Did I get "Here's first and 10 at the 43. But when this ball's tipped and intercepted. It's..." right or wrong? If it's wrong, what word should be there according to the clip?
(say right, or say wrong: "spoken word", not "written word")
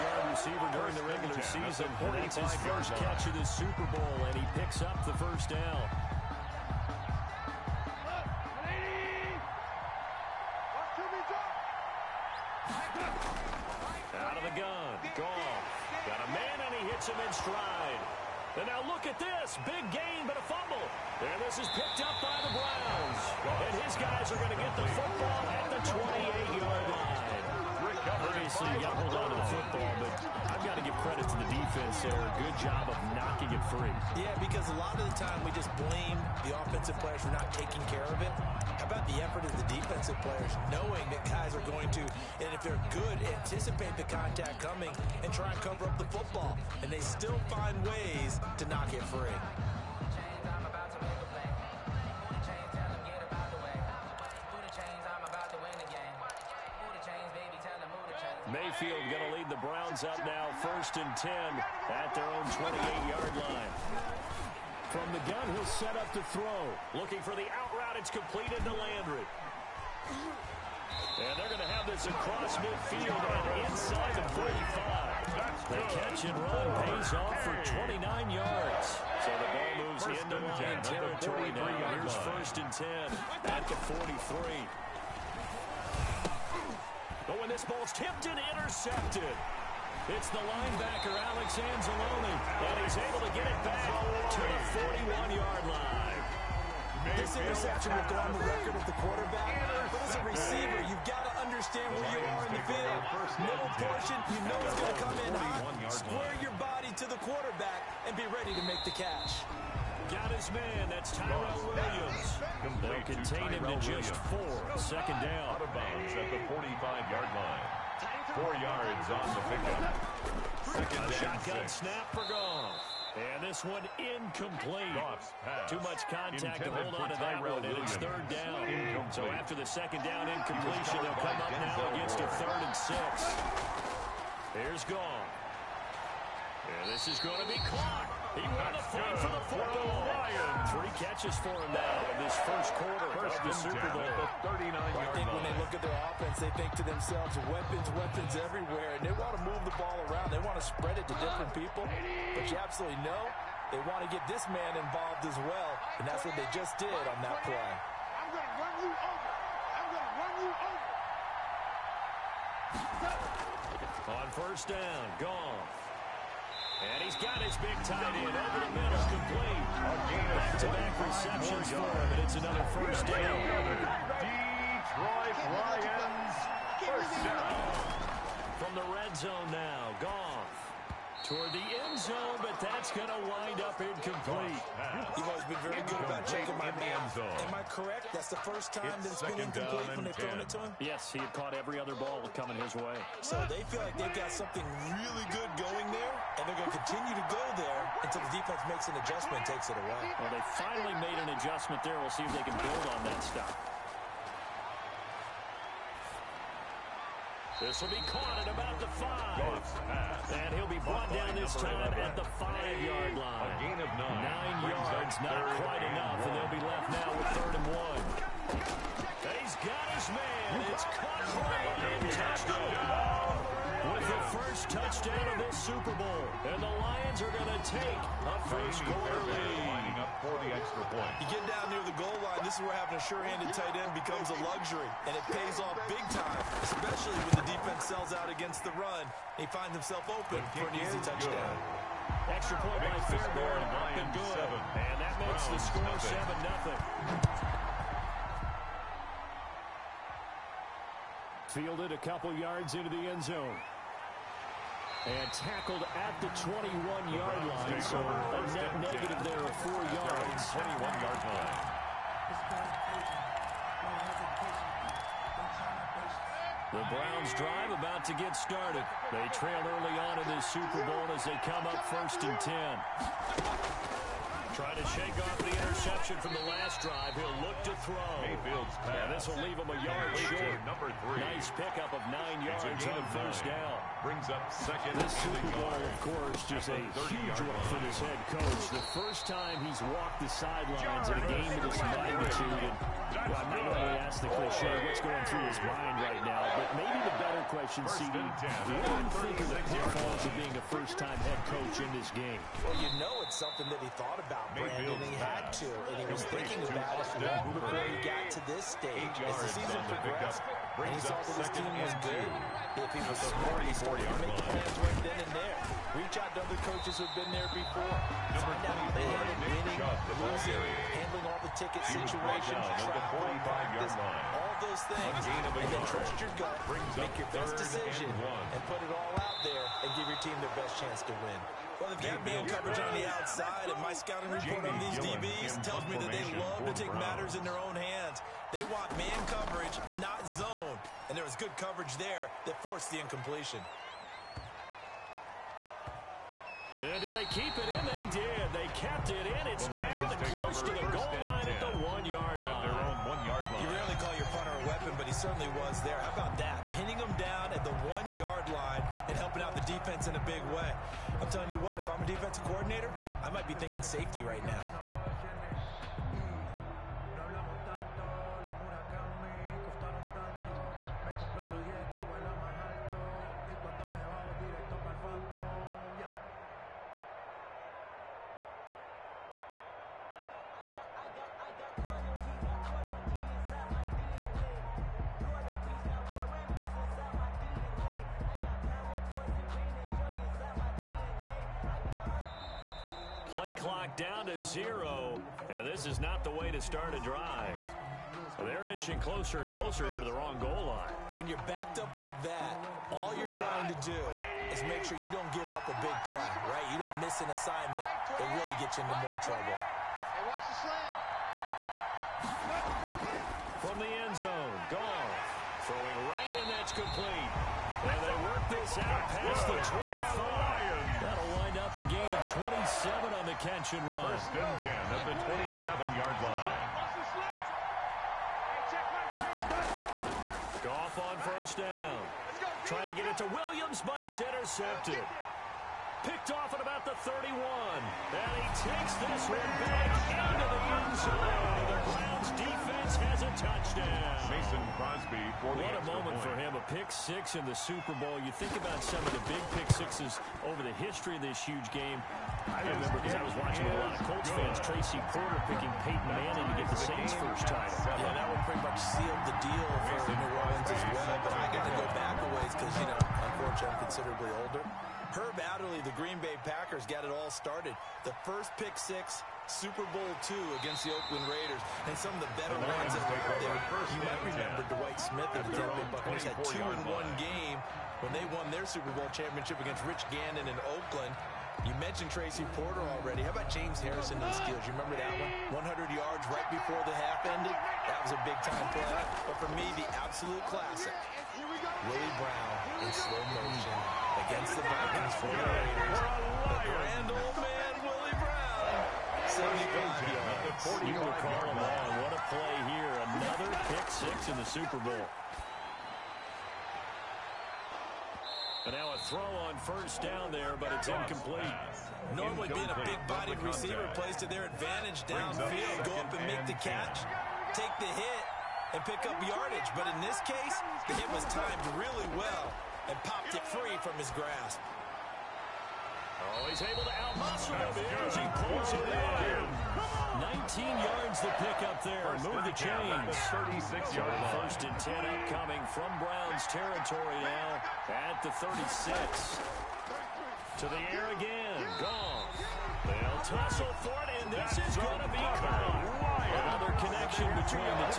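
right.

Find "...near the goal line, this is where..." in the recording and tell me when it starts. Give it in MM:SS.
03:51.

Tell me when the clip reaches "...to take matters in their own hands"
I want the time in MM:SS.
05:36.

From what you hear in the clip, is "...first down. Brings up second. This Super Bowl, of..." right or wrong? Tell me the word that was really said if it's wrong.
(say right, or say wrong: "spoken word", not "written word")
right.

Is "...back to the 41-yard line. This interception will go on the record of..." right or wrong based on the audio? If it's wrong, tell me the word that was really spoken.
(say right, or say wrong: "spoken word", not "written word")
right.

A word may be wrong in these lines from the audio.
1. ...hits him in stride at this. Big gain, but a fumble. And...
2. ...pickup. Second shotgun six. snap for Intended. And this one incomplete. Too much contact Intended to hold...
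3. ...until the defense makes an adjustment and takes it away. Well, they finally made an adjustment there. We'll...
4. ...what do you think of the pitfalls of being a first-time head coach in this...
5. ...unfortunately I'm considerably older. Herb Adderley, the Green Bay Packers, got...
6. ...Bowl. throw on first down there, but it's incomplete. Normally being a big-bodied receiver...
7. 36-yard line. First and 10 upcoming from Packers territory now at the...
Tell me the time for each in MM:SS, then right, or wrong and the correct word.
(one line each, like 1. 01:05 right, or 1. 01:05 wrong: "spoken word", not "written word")
1. 00:16 right
2. 01:59 wrong: "Goff", not "Intended"
3. 03:18 right
4. 04:58 right
5. 07:43 right
6. 08:24 right
7. 08:53 wrong: "Browns", not "Packers".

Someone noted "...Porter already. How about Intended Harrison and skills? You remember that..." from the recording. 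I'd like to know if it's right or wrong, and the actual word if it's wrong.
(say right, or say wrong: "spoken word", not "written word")
wrong: "James", not "Intended".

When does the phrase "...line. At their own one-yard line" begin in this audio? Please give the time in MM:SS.
05:52.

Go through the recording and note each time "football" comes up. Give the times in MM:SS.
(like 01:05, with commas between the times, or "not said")
00:24, 00:29, 00:46.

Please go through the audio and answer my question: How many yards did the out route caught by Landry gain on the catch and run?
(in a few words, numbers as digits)
29 yards.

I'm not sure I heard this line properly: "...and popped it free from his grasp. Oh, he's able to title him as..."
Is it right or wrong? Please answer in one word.
wrong.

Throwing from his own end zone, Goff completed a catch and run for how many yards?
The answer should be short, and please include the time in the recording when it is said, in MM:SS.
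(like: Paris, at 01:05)
27, at 07:02.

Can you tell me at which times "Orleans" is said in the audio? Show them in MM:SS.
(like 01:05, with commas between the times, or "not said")
07:40.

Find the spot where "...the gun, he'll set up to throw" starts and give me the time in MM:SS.
01:05.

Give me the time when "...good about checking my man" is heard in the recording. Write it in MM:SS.
03:05.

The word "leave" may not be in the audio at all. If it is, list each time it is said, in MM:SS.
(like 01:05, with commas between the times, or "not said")
04:39.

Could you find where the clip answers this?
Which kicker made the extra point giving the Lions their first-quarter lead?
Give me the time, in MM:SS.
04:03.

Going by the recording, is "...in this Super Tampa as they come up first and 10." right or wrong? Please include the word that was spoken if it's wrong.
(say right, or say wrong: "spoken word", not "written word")
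wrong: "Bowl", not "Tampa".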